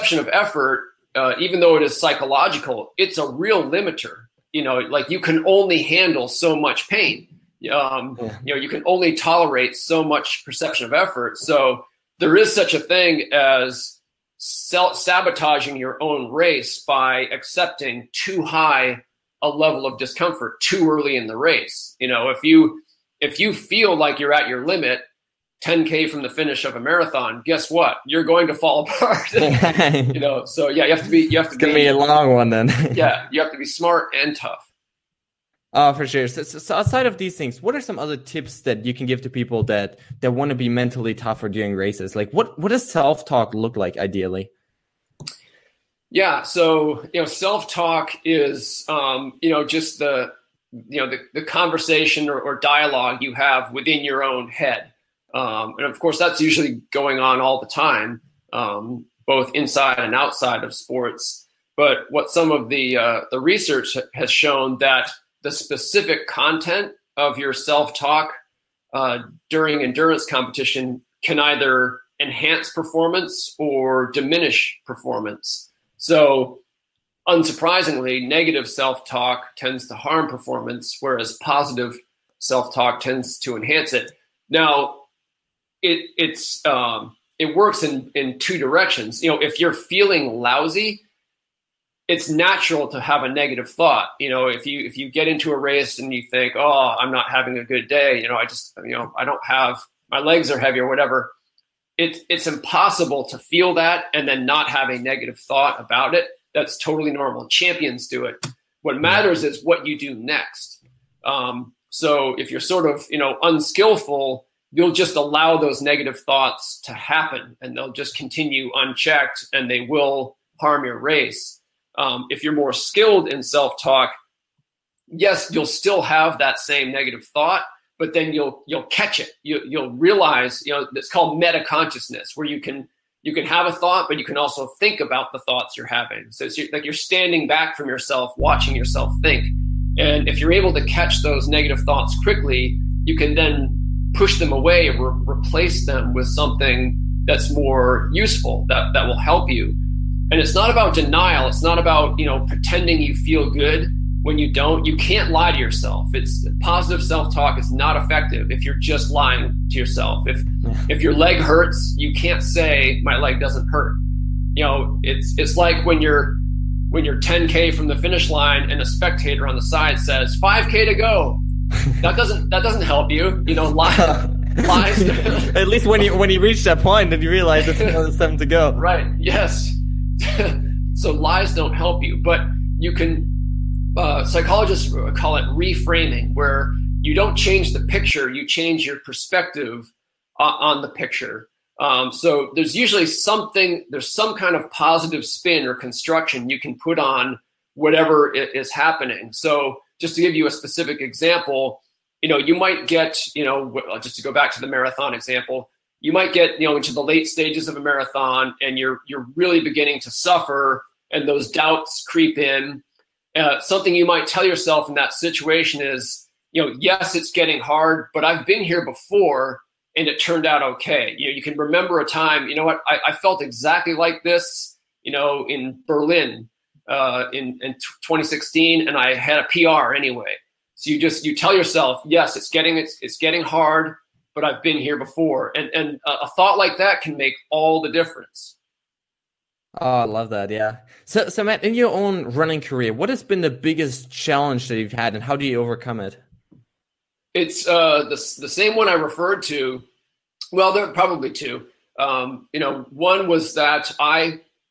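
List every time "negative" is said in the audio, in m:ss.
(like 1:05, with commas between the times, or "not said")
1:18, 1:33, 1:44, 1:55, 2:06, 2:21.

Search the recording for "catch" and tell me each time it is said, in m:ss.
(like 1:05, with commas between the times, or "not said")
2:08, 2:20.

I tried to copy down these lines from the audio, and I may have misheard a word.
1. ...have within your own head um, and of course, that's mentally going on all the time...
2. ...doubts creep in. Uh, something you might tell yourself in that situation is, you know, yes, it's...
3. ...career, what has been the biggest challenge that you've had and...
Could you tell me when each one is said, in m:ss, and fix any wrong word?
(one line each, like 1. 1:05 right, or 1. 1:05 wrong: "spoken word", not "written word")
1. 0:53 wrong: "usually", not "mentally"
2. 3:31 right
3. 4:02 right.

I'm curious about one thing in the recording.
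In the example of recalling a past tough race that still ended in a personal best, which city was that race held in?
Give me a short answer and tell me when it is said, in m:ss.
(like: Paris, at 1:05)
Berlin, at 3:45.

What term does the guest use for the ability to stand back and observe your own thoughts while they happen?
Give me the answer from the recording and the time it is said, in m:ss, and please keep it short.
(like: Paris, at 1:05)
meta consciousness, at 2:11.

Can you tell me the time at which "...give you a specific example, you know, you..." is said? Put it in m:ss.
3:20.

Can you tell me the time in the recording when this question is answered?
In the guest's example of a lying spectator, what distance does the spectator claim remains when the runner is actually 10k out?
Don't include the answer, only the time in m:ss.
2:50.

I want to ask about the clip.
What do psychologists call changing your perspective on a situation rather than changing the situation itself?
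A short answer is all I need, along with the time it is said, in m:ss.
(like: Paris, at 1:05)
reframing, at 3:05.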